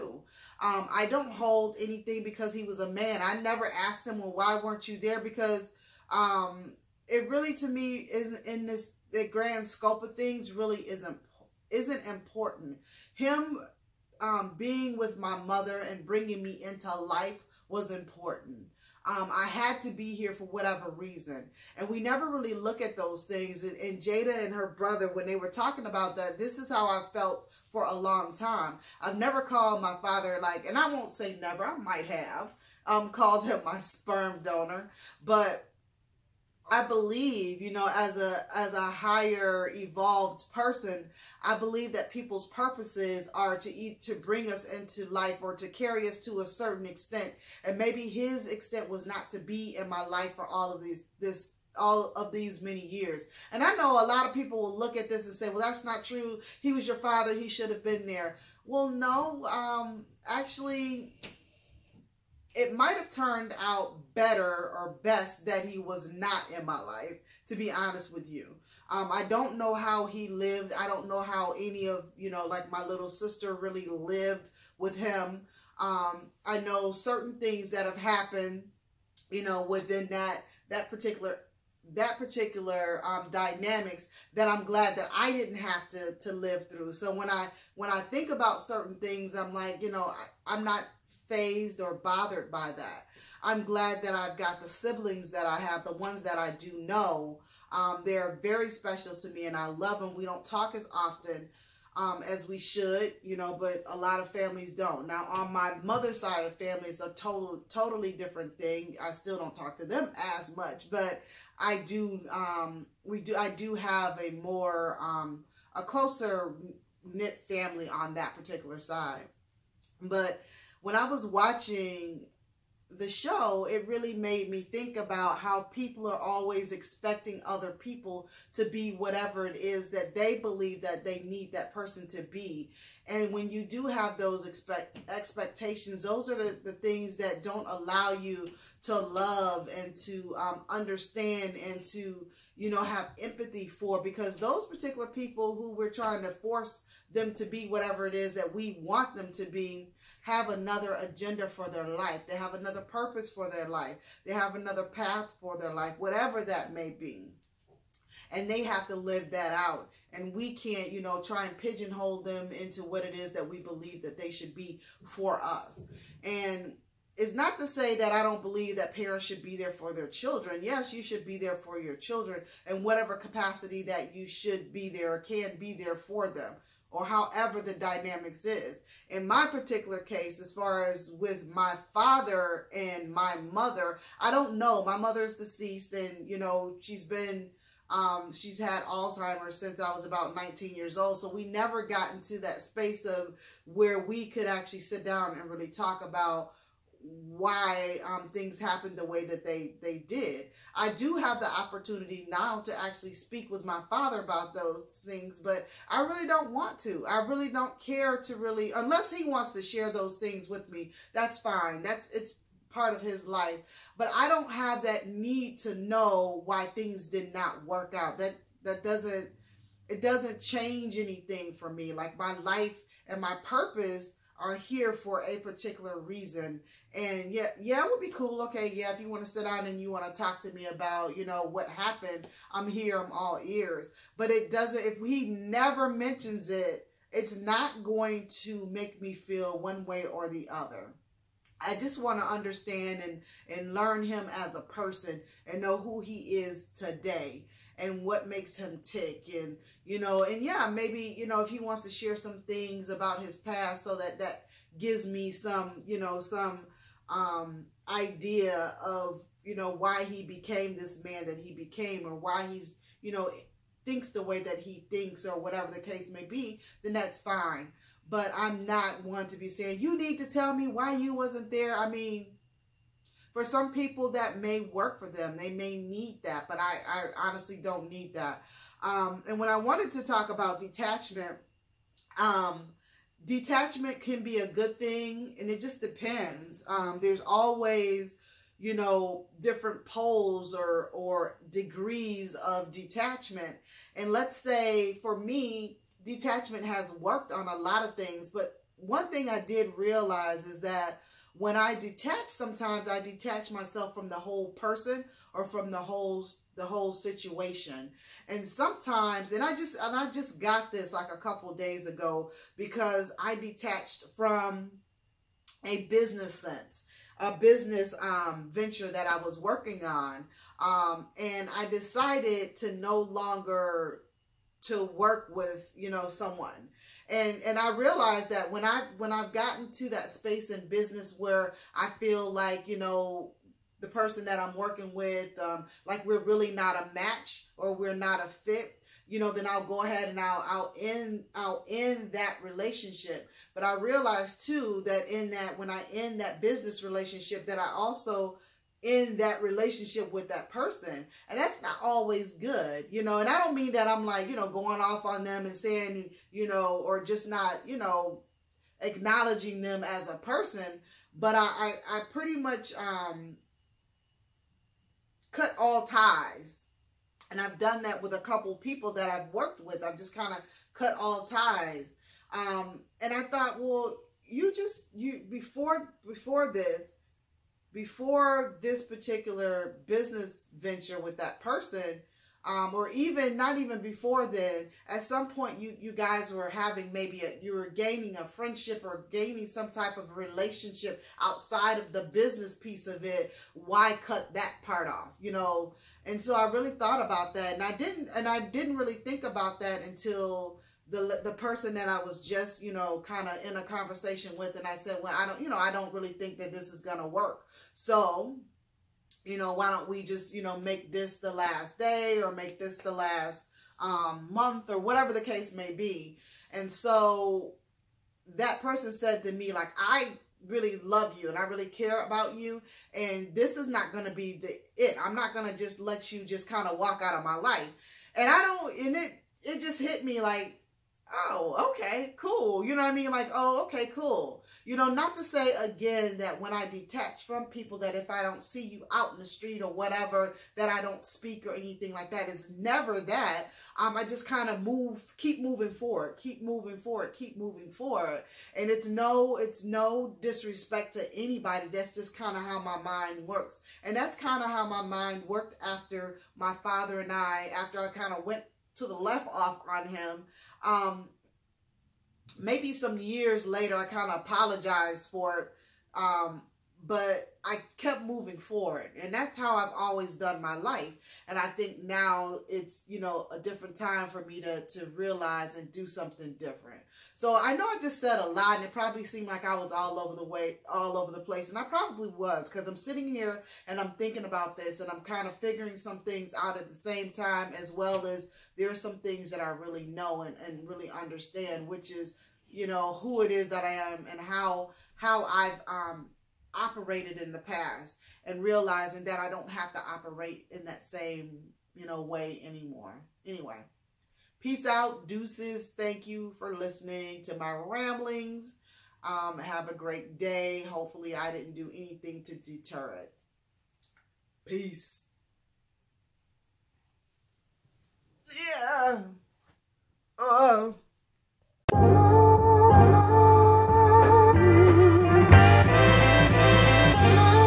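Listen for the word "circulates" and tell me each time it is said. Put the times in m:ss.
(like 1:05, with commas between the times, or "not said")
not said.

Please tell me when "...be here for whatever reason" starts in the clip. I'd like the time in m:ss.
0:19.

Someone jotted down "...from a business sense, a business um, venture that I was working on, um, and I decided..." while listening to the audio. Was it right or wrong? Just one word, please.
right.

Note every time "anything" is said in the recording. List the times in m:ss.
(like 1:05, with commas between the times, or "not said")
0:01, 3:40, 7:21, 8:31.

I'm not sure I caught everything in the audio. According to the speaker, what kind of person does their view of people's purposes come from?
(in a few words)
a higher evolved person.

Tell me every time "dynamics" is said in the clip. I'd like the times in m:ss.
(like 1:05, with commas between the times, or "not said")
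1:23, 2:57.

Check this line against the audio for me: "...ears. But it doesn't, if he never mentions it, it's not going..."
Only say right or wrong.
right.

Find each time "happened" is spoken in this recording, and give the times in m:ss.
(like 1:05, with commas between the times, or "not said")
1:17, 3:18, 3:51.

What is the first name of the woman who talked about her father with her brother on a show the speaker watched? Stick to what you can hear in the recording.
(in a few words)
Jada.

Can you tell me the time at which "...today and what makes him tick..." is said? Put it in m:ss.
4:06.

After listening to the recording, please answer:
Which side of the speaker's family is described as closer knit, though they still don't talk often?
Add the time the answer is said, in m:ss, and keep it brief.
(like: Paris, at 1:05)
mother's side, at 1:45.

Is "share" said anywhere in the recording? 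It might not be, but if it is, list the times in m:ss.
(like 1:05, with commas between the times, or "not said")
3:29, 4:11.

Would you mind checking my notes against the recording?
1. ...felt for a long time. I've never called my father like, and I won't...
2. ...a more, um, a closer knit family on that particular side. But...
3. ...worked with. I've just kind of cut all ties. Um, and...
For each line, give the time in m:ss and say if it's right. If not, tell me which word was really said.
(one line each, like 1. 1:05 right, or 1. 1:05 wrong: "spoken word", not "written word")
1. 0:27 right
2. 1:54 right
3. 6:09 right.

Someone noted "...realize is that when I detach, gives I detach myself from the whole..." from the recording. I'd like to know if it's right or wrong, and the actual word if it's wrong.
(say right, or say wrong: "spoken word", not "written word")
wrong: "sometimes", not "gives".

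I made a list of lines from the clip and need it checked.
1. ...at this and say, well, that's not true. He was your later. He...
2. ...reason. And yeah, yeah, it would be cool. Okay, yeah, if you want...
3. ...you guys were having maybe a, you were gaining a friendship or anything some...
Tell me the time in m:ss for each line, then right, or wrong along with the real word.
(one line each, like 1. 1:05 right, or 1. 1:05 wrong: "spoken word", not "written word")
1. 0:54 wrong: "father", not "later"
2. 3:45 right
3. 6:25 wrong: "gaining", not "anything".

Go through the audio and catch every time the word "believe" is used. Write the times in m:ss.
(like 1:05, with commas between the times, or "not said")
0:36, 0:41, 2:10, 2:43, 2:48.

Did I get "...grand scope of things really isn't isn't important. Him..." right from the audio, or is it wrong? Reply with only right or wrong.
right.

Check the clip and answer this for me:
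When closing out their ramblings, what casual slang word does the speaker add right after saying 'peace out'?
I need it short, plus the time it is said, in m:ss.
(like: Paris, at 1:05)
deuces, at 8:25.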